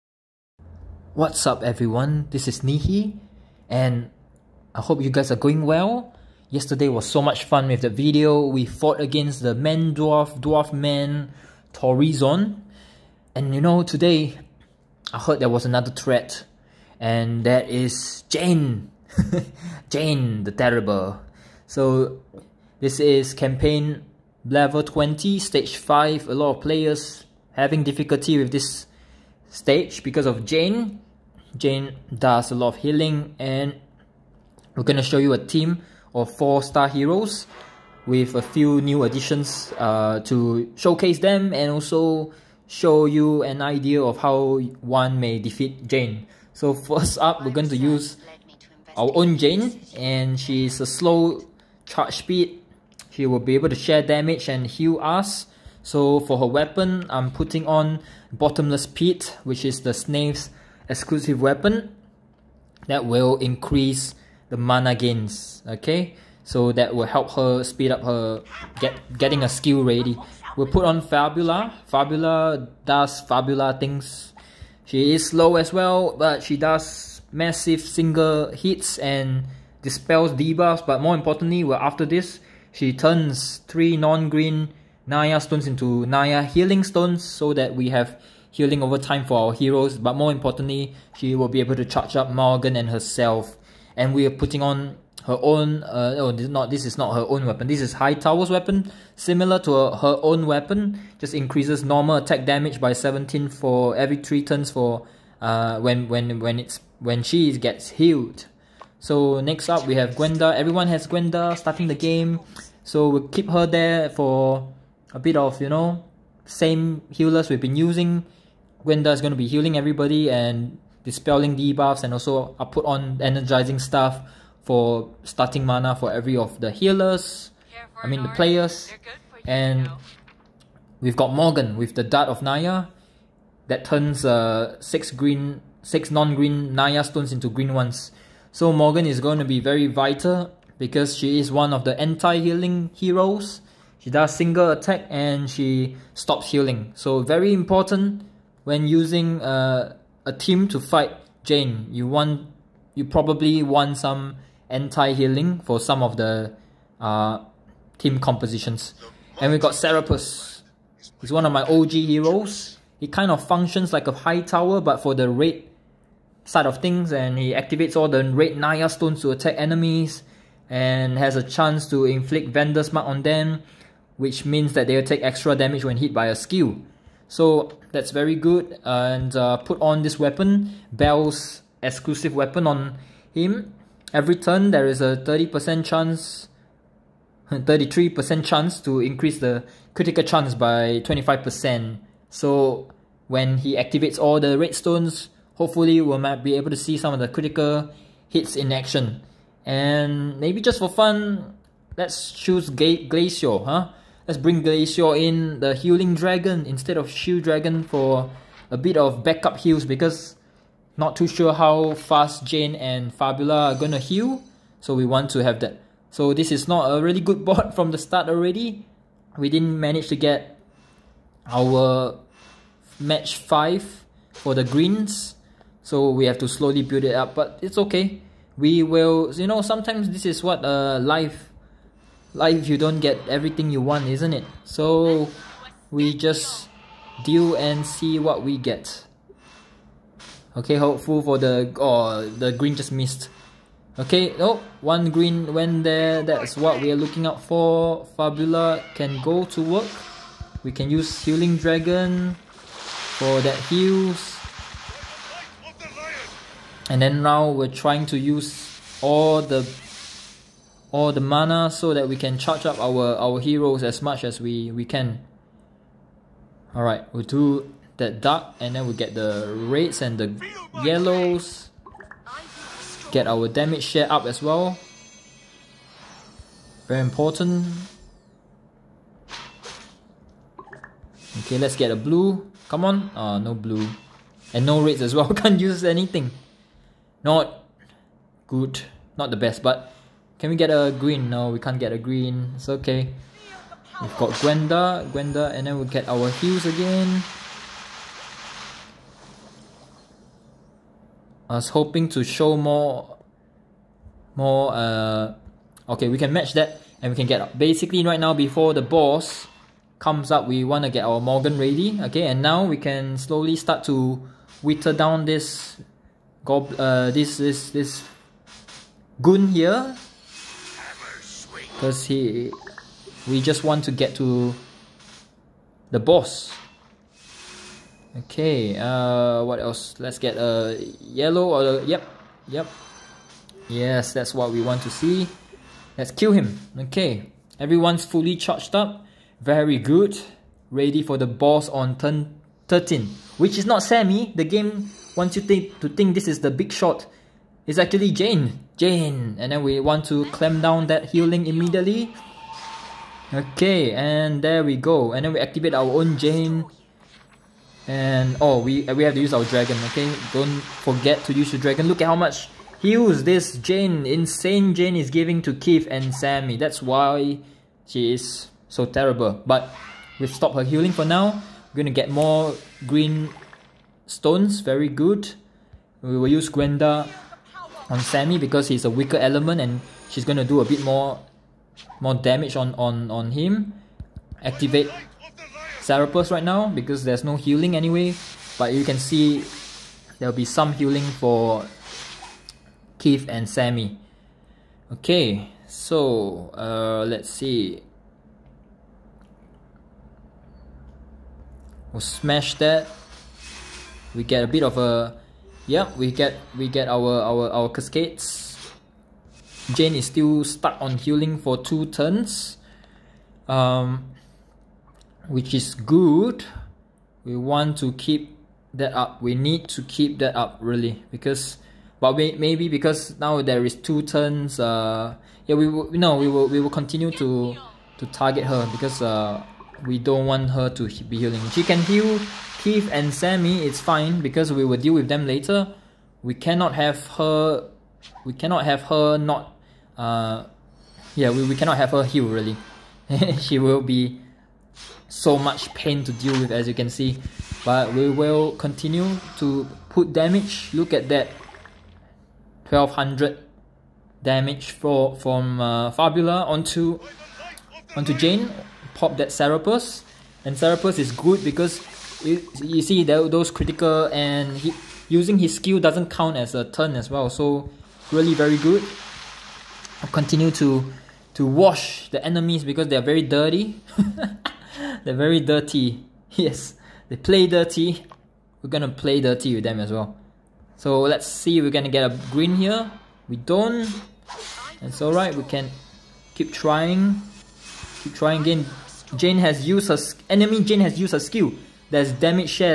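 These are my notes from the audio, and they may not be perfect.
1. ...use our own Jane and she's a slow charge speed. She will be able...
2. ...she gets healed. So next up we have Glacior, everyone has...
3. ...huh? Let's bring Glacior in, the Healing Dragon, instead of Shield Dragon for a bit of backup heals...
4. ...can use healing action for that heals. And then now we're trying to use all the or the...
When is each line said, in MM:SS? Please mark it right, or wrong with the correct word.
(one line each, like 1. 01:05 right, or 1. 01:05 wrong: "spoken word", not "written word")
1. 00:47 right
2. 01:47 wrong: "Gwenda", not "Glacior"
3. 03:23 right
4. 04:10 wrong: "dragon", not "action".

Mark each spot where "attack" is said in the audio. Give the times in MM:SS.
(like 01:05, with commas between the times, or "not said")
01:42, 02:24, 02:49.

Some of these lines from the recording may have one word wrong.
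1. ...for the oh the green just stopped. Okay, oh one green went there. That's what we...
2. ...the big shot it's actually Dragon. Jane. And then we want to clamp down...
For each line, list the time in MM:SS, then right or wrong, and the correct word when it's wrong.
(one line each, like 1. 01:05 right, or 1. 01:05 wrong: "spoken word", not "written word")
1. 04:01 wrong: "missed", not "stopped"
2. 05:46 wrong: "Jane", not "Dragon".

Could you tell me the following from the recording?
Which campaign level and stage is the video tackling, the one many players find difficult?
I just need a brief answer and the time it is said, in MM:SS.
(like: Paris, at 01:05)
Level 20, stage 5, at 00:23.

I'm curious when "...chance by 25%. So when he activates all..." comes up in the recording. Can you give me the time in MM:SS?
03:10.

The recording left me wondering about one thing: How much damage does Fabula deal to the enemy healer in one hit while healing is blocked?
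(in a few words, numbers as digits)
1200.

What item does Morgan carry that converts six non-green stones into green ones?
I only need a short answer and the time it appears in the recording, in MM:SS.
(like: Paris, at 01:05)
Dart of Naya, at 02:12.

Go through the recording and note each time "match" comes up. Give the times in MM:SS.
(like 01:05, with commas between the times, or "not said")
03:42, 05:06.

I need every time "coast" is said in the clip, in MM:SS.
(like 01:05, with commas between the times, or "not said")
not said.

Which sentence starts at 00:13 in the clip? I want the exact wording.
And you know, today I heard there was another threat, and that is Jane.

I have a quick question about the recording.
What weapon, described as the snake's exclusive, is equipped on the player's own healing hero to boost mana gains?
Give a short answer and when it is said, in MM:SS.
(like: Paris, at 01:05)
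Bottomless Pit, at 00:58.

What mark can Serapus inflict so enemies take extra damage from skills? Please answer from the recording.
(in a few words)
Vendor's Mark.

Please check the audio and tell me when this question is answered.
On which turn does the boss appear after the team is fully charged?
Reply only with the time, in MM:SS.
05:41.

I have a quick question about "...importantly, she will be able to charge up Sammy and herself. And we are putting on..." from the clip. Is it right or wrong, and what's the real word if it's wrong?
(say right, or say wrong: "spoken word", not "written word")
wrong: "Morgan", not "Sammy".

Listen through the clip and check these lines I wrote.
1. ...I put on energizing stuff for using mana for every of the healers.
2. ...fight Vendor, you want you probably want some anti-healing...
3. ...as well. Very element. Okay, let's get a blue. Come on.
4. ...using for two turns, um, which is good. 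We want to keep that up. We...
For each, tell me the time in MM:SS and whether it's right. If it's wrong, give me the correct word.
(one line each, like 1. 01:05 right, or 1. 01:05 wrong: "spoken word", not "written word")
1. 02:02 wrong: "starting", not "using"
2. 02:30 wrong: "Jane", not "Vendor"
3. 04:34 wrong: "important", not "element"
4. 06:51 wrong: "healing", not "using".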